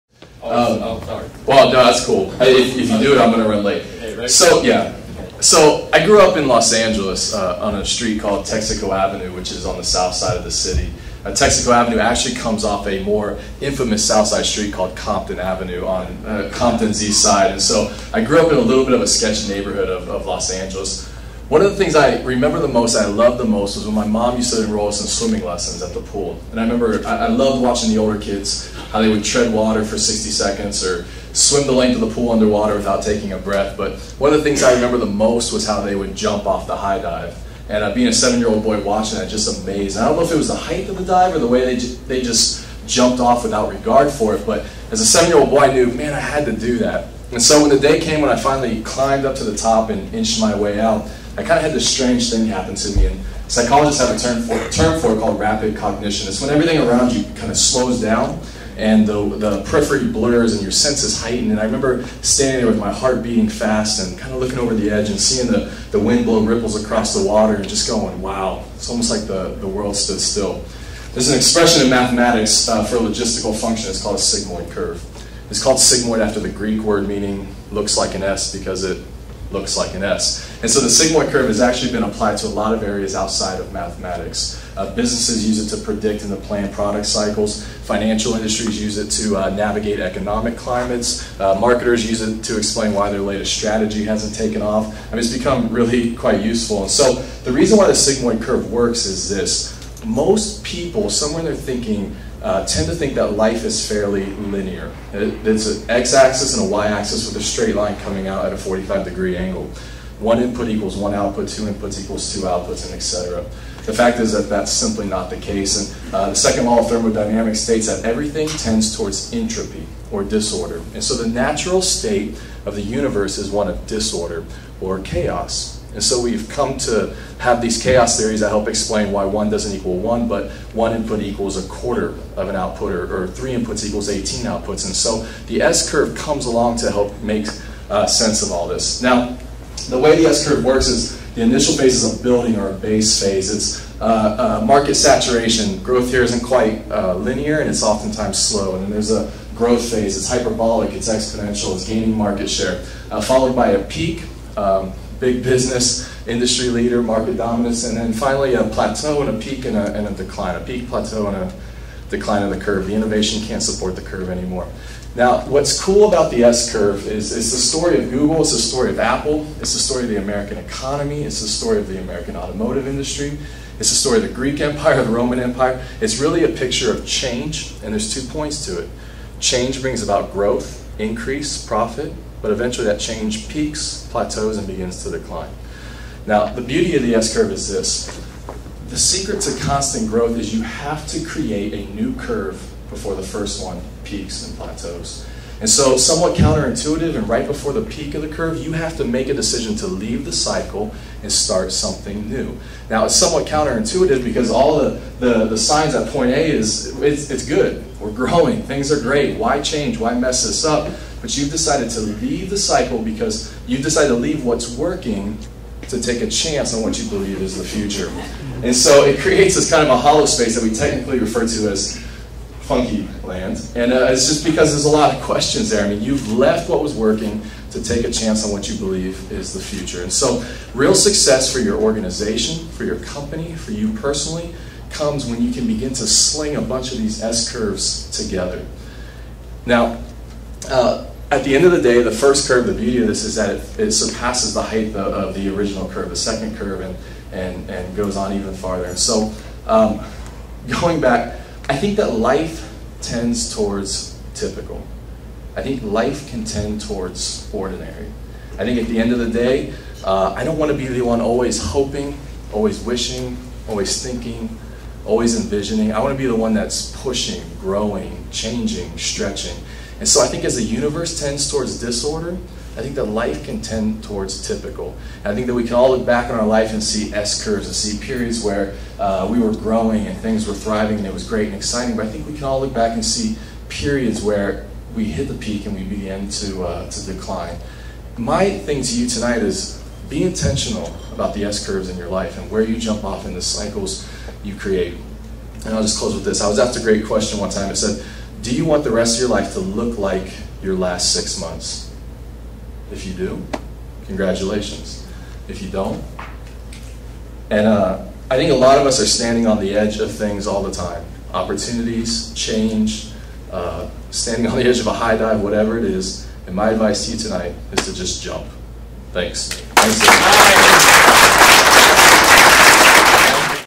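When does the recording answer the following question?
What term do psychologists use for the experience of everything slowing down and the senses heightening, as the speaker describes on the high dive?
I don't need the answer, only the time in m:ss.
0:55.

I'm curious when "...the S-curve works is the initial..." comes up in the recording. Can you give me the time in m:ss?
2:20.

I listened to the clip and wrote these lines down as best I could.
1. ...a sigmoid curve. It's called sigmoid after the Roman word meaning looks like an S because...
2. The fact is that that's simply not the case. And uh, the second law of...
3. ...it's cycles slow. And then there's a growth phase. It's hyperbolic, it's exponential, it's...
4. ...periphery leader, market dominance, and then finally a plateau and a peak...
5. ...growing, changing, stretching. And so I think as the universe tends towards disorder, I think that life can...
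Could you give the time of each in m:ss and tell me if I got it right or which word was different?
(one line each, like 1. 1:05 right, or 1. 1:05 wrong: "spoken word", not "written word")
1. 1:14 wrong: "Greek", not "Roman"
2. 1:53 right
3. 2:27 wrong: "oftentimes", not "cycles"
4. 2:36 wrong: "industry", not "periphery"
5. 4:27 right.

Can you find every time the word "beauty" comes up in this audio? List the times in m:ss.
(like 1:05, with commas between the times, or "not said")
3:06, 4:02.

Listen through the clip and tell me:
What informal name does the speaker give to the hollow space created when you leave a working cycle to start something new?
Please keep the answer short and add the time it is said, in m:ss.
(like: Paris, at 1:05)
Funky land, at 3:42.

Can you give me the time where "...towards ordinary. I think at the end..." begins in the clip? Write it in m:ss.
4:16.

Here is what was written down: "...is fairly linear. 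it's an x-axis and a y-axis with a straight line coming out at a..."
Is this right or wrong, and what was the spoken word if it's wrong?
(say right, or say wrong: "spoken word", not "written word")
right.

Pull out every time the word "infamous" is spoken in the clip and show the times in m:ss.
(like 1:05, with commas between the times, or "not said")
0:13.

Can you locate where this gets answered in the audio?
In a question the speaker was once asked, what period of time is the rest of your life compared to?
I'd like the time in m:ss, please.
5:00.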